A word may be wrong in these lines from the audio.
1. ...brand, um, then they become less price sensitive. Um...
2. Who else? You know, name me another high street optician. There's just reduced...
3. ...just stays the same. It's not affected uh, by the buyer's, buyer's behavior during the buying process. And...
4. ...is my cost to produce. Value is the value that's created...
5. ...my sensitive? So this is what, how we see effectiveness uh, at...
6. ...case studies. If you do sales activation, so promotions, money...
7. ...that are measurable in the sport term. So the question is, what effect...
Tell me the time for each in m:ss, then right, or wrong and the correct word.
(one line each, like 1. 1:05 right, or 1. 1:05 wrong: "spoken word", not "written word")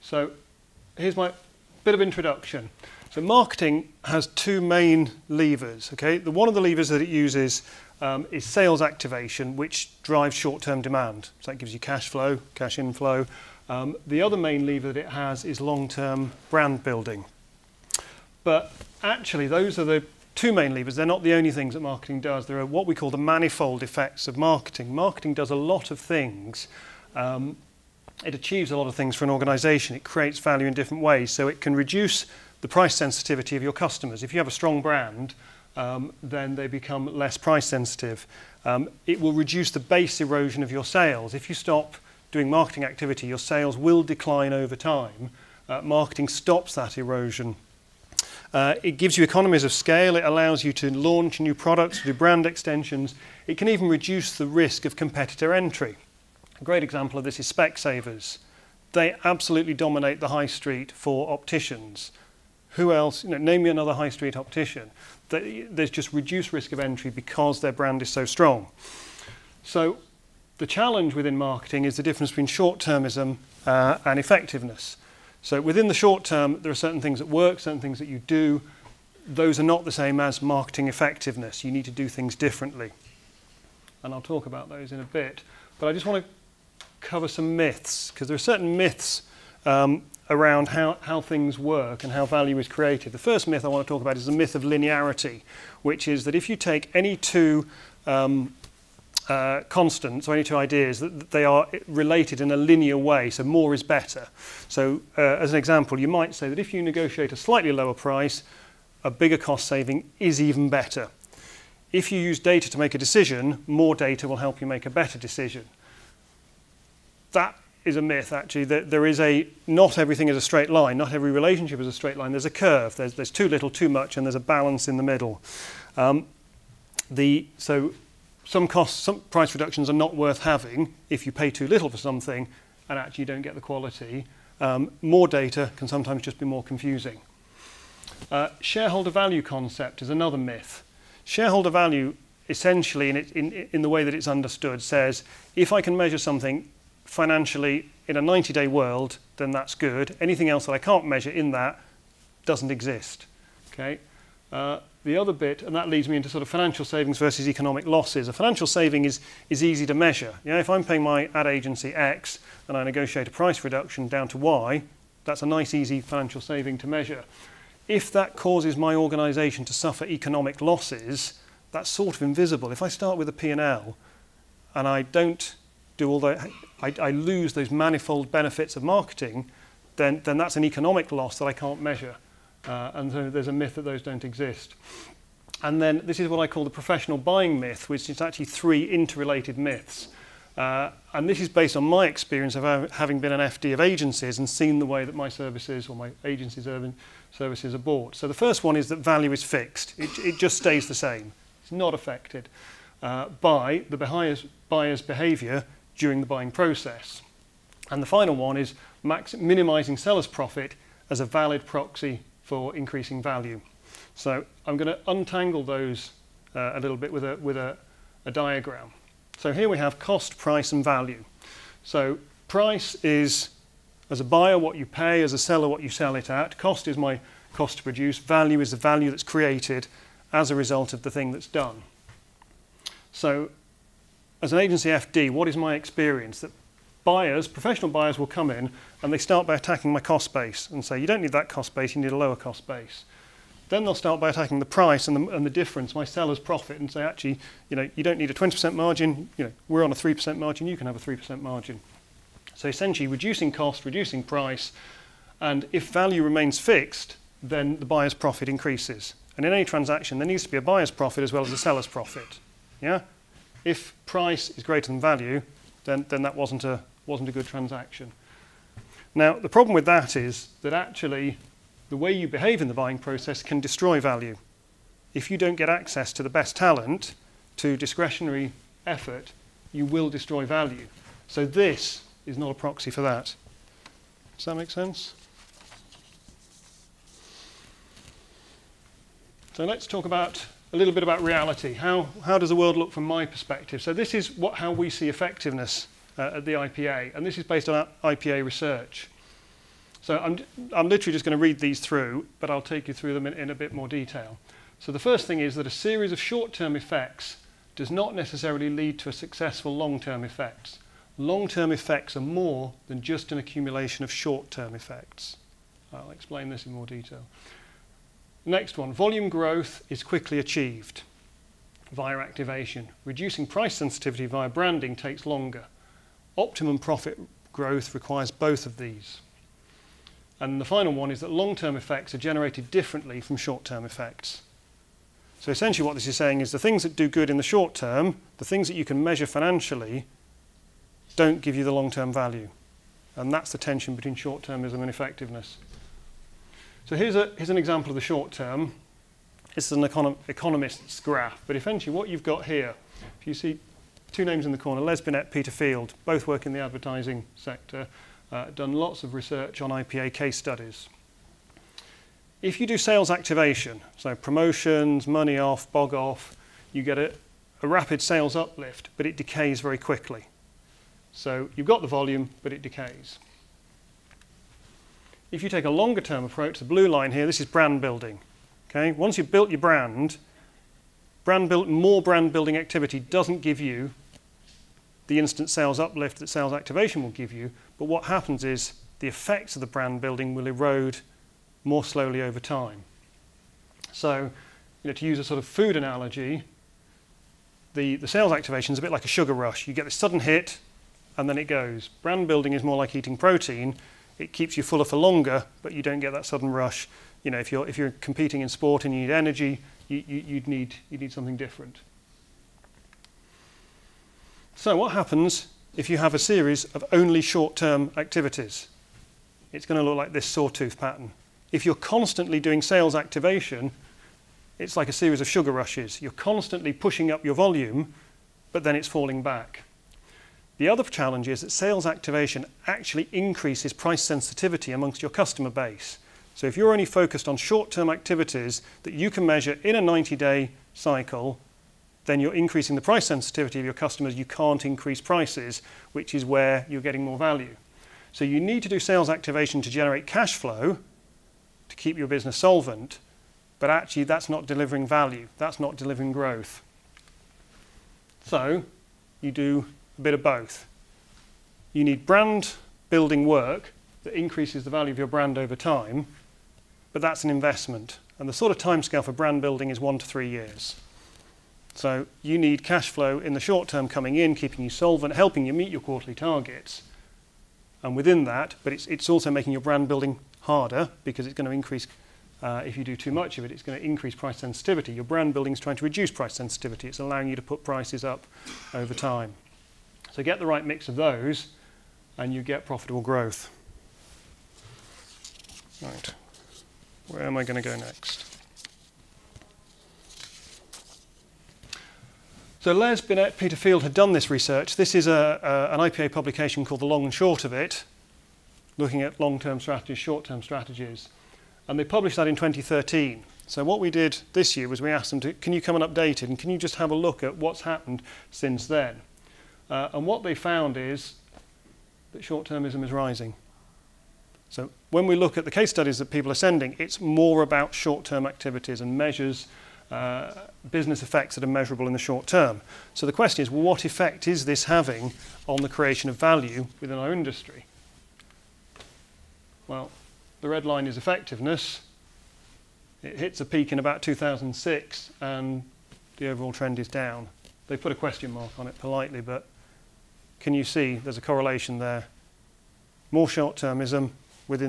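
1. 0:34 right
2. 1:02 right
3. 3:20 right
4. 3:46 right
5. 4:53 wrong: "perspective", not "sensitive"
6. 6:00 right
7. 8:51 wrong: "short", not "sport".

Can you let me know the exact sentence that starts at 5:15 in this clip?
I'll explain this in more detail.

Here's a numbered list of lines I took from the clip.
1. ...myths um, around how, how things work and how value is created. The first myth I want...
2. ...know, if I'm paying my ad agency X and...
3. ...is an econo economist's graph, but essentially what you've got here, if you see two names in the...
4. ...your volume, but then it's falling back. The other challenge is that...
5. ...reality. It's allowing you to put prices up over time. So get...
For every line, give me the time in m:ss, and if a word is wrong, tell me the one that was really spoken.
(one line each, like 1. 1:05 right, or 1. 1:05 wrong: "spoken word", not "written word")
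1. 1:28 right
2. 2:40 right
3. 5:49 right
4. 7:07 right
5. 8:06 wrong: "sensitivity", not "reality".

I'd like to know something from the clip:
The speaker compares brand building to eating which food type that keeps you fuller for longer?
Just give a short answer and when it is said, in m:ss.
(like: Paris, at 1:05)
protein, at 6:43.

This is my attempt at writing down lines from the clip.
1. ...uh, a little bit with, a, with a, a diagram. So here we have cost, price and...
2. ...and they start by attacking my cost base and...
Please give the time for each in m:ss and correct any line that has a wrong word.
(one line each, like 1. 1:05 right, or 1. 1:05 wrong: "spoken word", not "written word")
1. 3:36 right
2. 3:59 right.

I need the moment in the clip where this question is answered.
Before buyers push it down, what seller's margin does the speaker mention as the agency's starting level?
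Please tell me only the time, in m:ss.
4:08.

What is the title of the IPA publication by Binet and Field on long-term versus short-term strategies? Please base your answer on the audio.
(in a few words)
The Long and Short of It.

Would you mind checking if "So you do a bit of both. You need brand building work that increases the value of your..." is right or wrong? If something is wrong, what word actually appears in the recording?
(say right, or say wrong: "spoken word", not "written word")
right.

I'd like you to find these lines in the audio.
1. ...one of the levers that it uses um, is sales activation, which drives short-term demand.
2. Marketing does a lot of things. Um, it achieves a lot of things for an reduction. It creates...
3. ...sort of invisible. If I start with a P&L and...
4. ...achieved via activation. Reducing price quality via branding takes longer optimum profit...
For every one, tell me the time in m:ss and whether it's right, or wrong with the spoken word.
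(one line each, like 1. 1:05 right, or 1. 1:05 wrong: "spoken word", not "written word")
1. 0:06 right
2. 0:24 wrong: "organization", not "reduction"
3. 2:51 right
4. 5:20 wrong: "sensitivity", not "quality".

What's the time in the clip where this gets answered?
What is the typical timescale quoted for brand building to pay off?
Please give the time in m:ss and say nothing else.
7:49.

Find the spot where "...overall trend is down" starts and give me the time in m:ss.
9:06.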